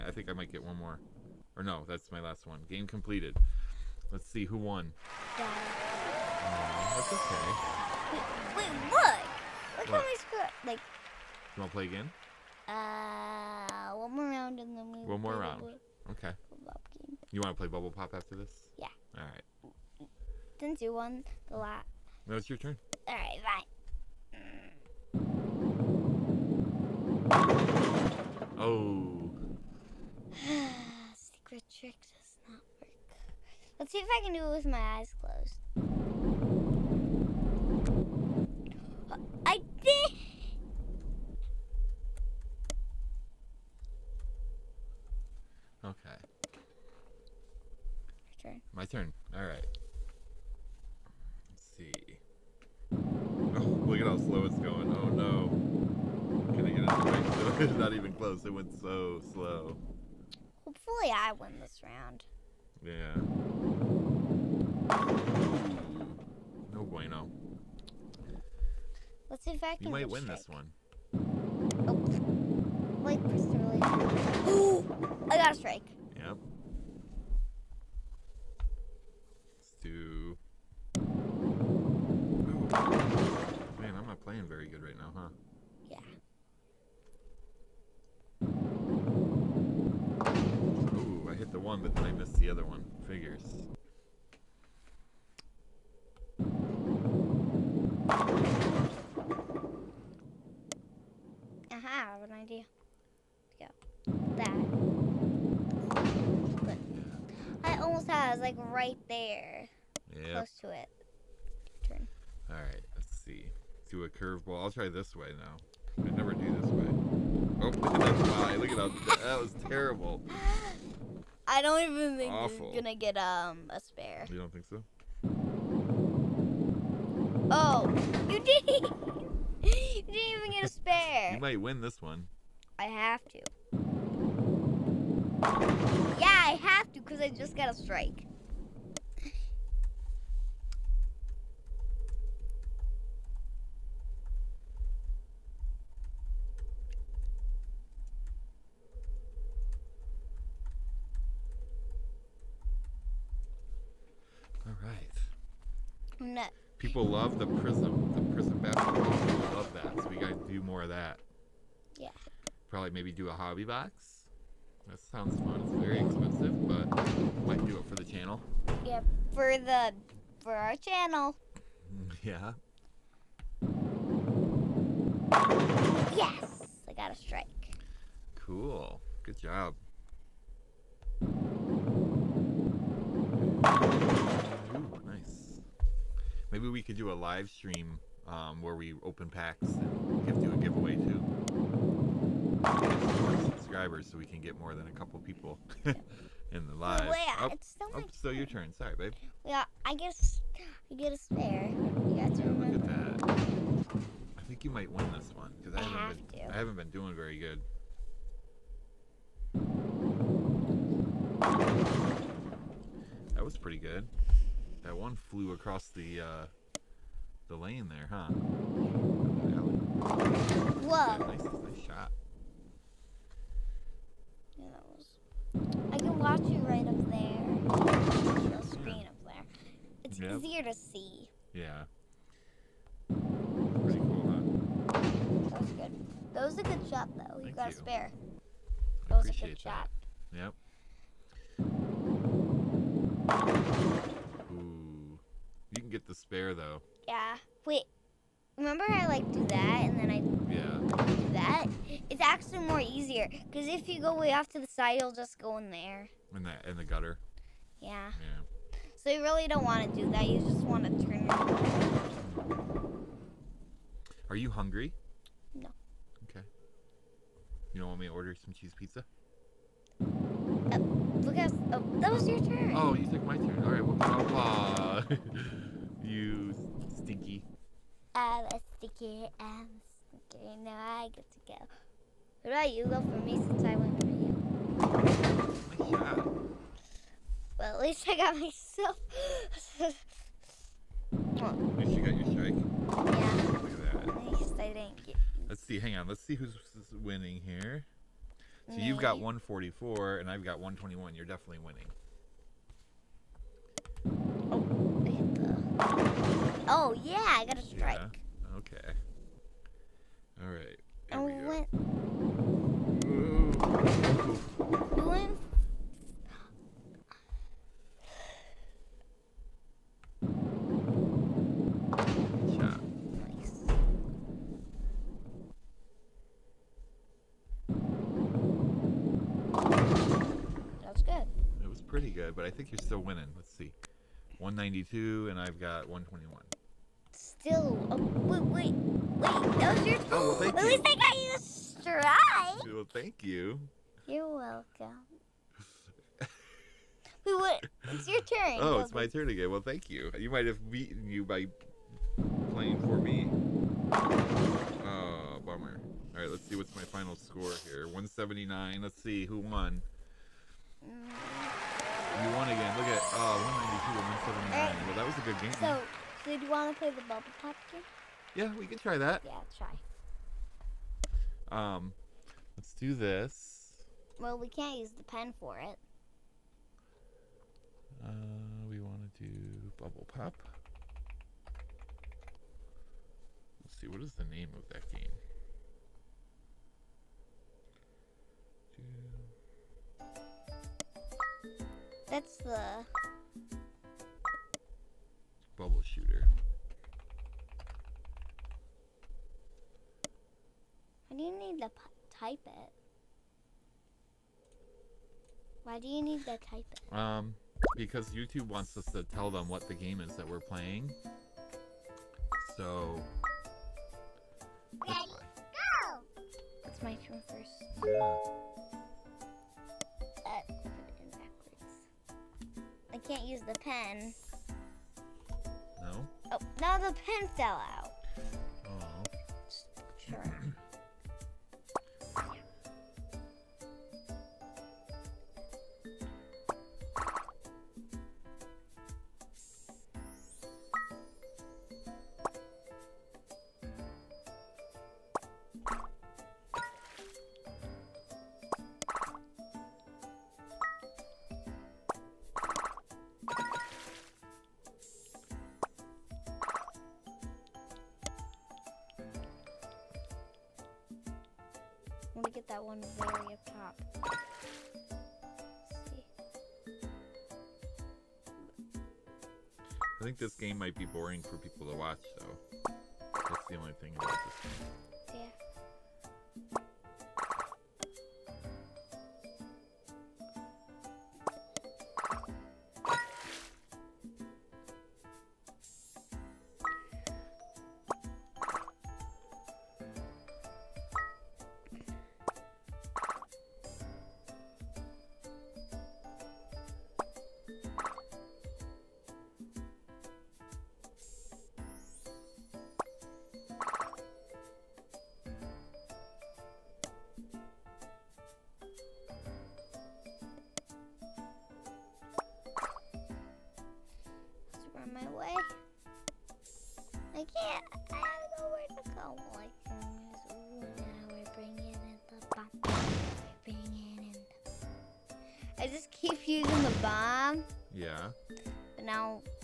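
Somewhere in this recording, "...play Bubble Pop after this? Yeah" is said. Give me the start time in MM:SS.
00:17.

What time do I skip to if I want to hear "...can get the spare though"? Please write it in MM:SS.
04:05.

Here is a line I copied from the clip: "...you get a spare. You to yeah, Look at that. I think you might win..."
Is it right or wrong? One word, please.
right.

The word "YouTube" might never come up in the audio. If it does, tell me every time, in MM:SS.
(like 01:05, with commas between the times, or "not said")
06:48.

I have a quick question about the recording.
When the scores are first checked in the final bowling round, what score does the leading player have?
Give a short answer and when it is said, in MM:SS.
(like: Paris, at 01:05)
144, at 04:59.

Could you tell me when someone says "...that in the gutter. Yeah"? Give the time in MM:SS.
04:16.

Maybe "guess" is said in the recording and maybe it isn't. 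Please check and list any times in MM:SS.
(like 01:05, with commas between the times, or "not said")
03:19.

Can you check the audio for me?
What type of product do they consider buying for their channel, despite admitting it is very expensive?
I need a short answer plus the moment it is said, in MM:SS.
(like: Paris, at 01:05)
hobby box, at 02:43.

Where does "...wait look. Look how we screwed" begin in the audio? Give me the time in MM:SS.
00:08.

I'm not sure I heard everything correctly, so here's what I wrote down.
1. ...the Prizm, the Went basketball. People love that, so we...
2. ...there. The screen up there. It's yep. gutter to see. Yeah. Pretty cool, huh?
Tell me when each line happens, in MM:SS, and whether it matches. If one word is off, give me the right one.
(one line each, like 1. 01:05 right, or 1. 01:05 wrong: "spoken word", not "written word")
1. 02:37 wrong: "Prizm", not "Went"
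2. 03:47 wrong: "easier", not "gutter".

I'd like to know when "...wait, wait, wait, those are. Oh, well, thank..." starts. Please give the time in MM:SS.
05:37.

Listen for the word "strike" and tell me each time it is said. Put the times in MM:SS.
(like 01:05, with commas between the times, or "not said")
01:15, 02:17, 02:57, 04:52, 05:07, 05:41.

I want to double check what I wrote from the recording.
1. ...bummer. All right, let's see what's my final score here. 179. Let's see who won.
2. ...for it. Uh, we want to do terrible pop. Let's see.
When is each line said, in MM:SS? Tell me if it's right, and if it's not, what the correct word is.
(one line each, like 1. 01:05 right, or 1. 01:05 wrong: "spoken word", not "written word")
1. 05:55 right
2. 06:15 wrong: "bubble", not "terrible".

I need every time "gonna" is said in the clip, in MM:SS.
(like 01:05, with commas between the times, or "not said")
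02:02.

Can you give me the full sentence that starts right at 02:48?
Yeah, for the for our channel.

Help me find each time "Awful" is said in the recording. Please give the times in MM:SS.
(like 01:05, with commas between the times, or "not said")
02:02.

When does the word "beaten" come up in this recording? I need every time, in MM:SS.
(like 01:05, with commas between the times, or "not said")
05:50.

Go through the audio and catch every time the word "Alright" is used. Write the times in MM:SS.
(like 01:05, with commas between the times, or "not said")
01:52.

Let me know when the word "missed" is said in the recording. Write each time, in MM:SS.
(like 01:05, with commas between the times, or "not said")
01:32.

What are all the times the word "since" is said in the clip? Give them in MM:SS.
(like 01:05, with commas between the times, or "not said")
00:20, 04:43.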